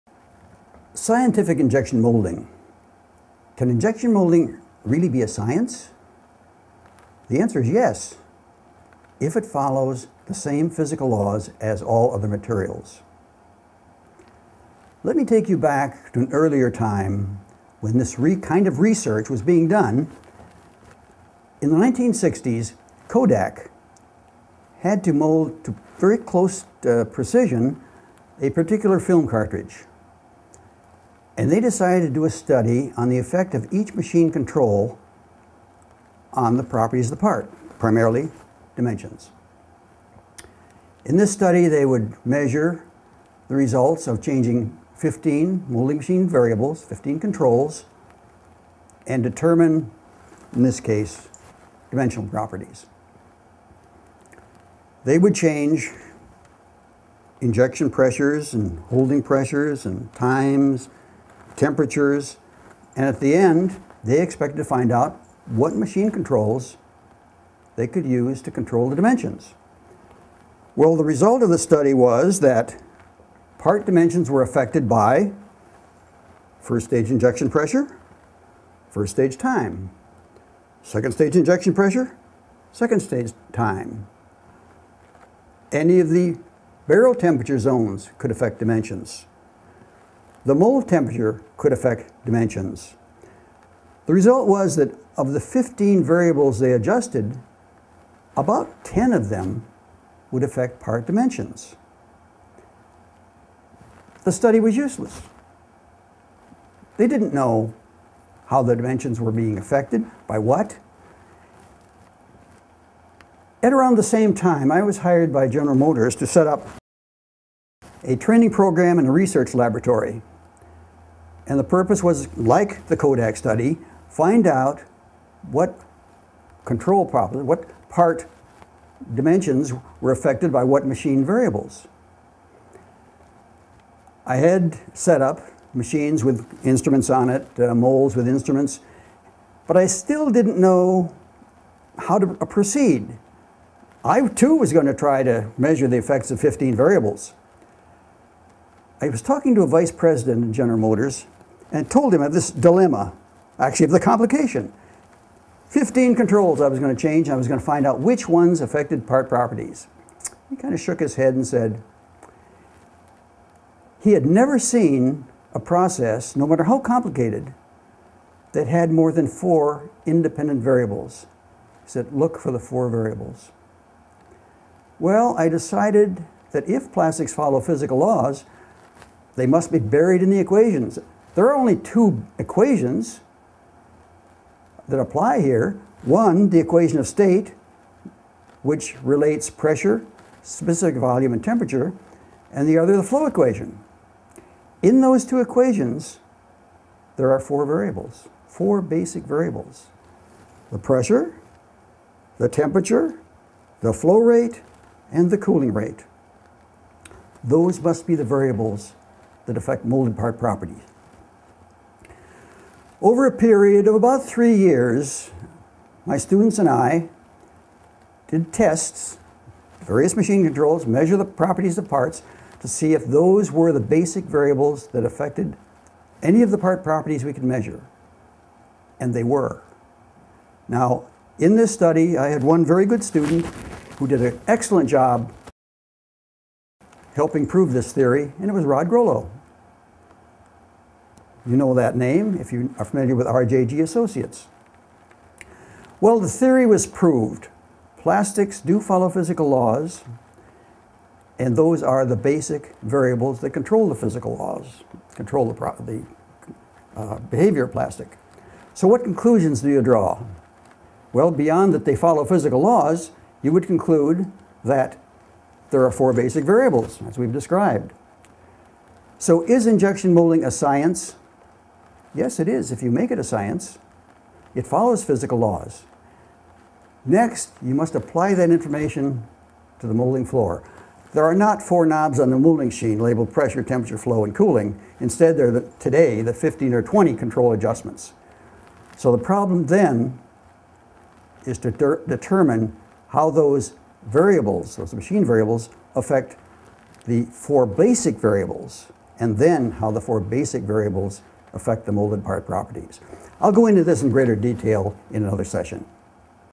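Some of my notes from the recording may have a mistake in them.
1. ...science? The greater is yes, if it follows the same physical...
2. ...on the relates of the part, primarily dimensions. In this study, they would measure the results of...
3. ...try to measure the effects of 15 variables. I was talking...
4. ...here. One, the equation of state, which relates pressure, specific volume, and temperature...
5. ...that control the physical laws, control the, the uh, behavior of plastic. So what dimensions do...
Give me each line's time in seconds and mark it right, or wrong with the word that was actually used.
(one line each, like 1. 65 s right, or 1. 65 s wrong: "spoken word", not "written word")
1. 5 s wrong: "answer", not "greater"
2. 36 s wrong: "properties", not "relates"
3. 144 s right
4. 185 s right
5. 253 s wrong: "conclusions", not "dimensions".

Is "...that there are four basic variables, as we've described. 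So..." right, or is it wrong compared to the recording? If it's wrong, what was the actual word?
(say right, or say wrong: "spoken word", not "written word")
right.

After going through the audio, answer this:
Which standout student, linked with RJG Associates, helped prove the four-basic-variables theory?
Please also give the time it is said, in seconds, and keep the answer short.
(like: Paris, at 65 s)
Rod Groleau, at 238 s.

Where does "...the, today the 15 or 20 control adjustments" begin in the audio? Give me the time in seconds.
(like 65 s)
285 s.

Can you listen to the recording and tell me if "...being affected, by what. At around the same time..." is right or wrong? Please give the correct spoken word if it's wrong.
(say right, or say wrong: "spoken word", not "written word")
right.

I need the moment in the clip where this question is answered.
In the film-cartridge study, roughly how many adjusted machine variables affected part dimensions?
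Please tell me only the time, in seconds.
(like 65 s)
98 s.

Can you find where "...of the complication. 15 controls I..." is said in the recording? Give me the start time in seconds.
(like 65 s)
153 s.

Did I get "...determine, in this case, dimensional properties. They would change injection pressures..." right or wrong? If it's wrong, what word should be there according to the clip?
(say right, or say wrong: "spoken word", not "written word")
right.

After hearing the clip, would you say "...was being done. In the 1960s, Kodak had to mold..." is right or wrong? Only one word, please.
right.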